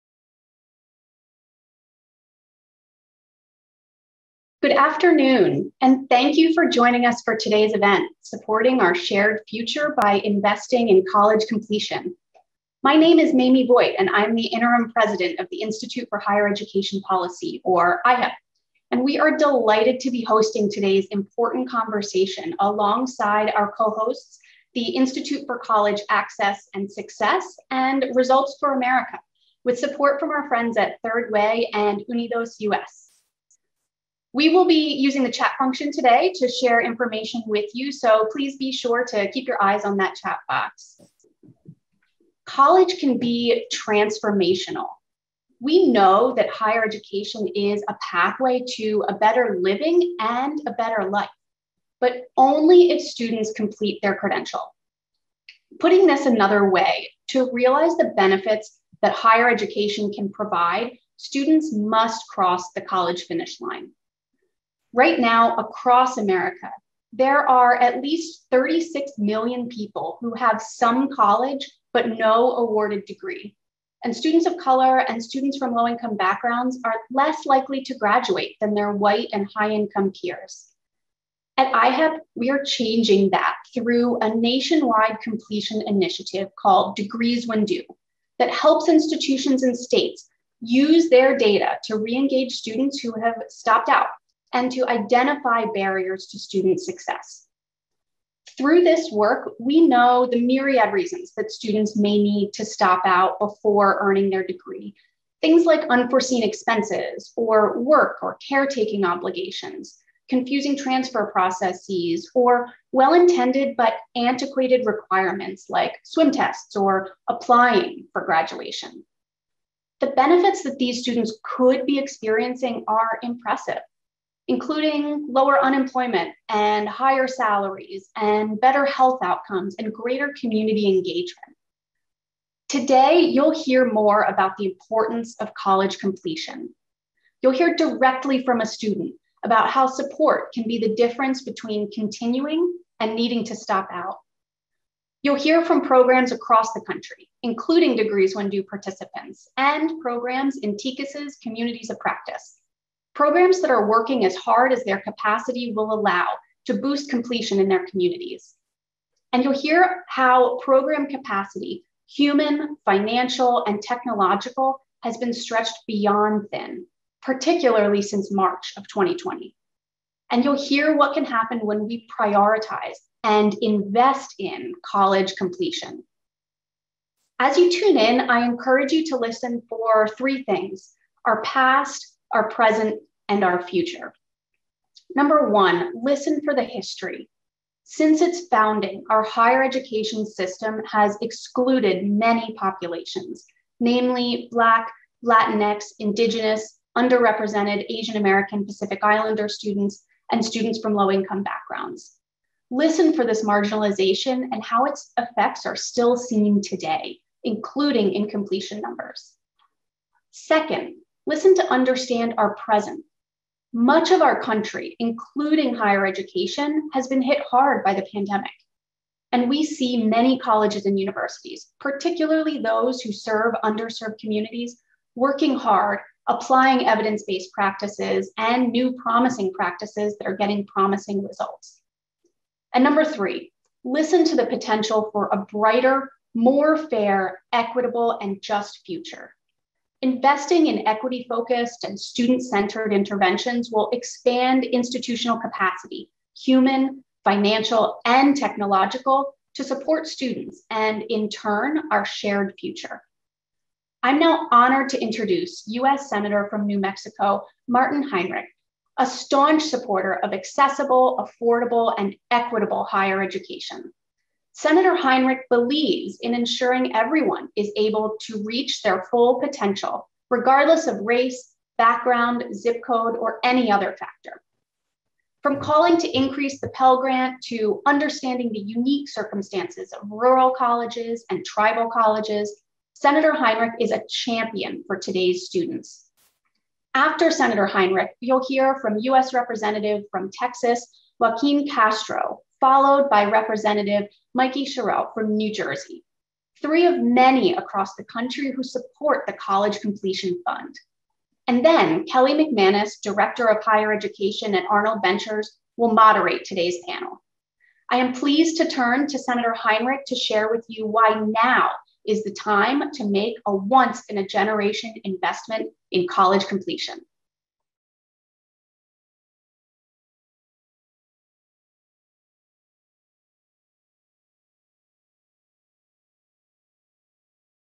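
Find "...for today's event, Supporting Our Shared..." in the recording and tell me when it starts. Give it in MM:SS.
00:07.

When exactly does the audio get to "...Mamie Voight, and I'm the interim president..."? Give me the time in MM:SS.
00:13.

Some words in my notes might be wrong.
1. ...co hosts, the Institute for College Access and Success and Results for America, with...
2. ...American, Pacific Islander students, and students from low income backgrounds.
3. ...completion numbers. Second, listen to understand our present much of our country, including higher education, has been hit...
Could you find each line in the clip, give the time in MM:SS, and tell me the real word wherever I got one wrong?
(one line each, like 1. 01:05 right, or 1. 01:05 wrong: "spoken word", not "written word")
1. 00:23 right
2. 03:18 right
3. 03:28 right.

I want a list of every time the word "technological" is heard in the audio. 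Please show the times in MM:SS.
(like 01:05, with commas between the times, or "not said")
02:43, 04:08.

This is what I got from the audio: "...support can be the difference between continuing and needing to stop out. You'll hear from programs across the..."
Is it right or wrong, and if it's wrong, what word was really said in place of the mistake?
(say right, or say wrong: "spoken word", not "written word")
right.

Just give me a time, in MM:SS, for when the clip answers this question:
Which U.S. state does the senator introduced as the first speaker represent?
04:16.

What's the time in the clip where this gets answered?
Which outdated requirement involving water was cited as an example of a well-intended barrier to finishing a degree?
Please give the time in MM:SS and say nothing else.
01:56.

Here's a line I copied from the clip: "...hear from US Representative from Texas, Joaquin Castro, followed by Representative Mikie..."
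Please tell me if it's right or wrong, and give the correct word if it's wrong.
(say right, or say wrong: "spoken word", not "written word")
right.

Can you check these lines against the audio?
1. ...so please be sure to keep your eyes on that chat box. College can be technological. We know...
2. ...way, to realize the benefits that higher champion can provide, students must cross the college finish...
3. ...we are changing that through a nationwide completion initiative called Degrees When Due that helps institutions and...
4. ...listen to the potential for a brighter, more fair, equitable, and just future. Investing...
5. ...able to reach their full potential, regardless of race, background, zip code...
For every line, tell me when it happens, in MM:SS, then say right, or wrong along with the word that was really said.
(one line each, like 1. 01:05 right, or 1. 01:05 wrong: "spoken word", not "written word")
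1. 00:37 wrong: "transformational", not "technological"
2. 00:56 wrong: "education", not "champion"
3. 01:22 right
4. 03:53 right
5. 04:27 right.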